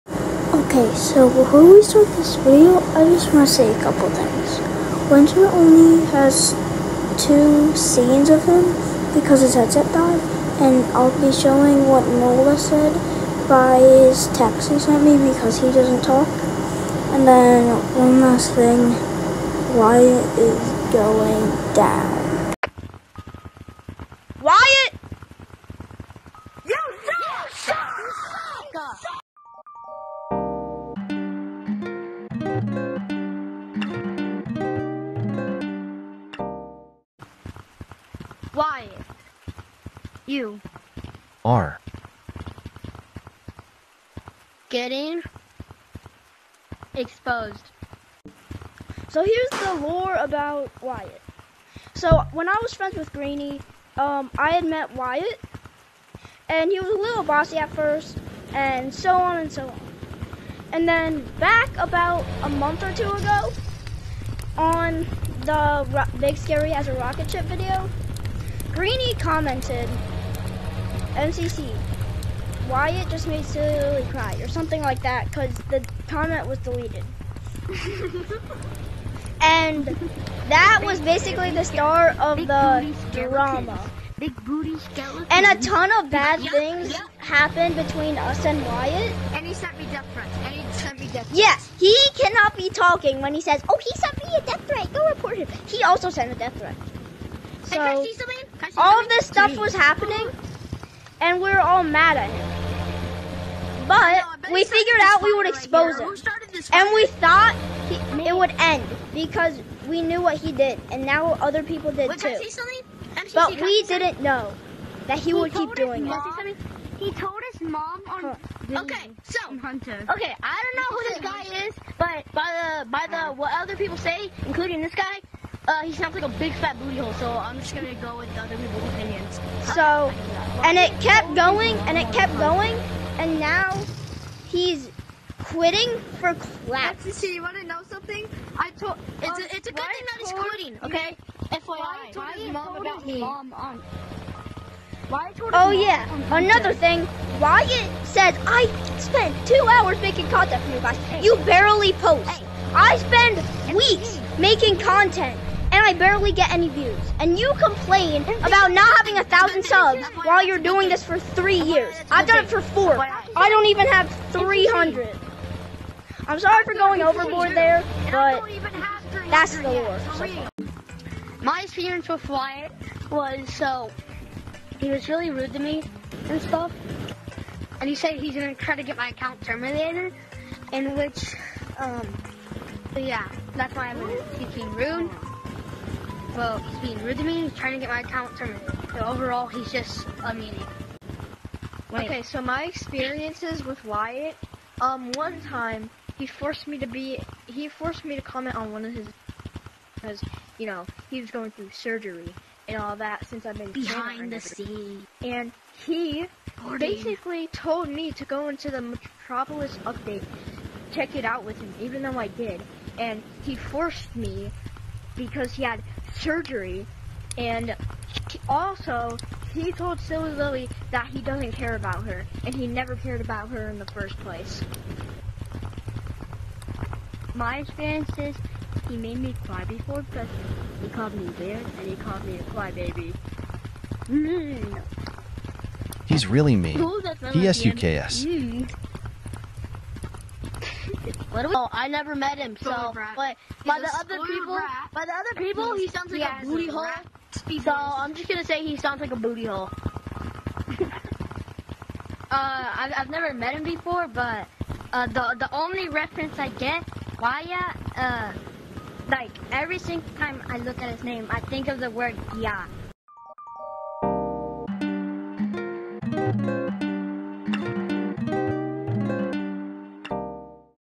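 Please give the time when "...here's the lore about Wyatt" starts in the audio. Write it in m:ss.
0:49.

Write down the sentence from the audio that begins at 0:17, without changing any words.
And then one last thing, why is going down?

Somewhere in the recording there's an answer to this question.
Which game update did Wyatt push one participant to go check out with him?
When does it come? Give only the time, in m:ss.
3:28.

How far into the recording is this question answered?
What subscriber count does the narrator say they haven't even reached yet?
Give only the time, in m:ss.
2:44.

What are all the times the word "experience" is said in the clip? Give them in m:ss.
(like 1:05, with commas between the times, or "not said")
2:51, 3:12, 3:47.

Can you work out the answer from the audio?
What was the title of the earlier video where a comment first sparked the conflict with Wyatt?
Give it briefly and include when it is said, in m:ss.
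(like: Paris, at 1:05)
Big Scary as a Rocket Ship, at 1:06.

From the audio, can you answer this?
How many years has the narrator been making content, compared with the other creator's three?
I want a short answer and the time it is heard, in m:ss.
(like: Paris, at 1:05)
4, at 2:42.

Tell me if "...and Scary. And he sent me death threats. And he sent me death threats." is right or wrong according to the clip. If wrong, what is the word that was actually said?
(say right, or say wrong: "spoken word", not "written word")
wrong: "Wyatt", not "Scary".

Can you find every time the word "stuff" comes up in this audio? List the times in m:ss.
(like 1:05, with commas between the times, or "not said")
1:39, 2:56.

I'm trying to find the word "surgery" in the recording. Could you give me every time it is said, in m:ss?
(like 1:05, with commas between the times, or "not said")
3:21, 3:36.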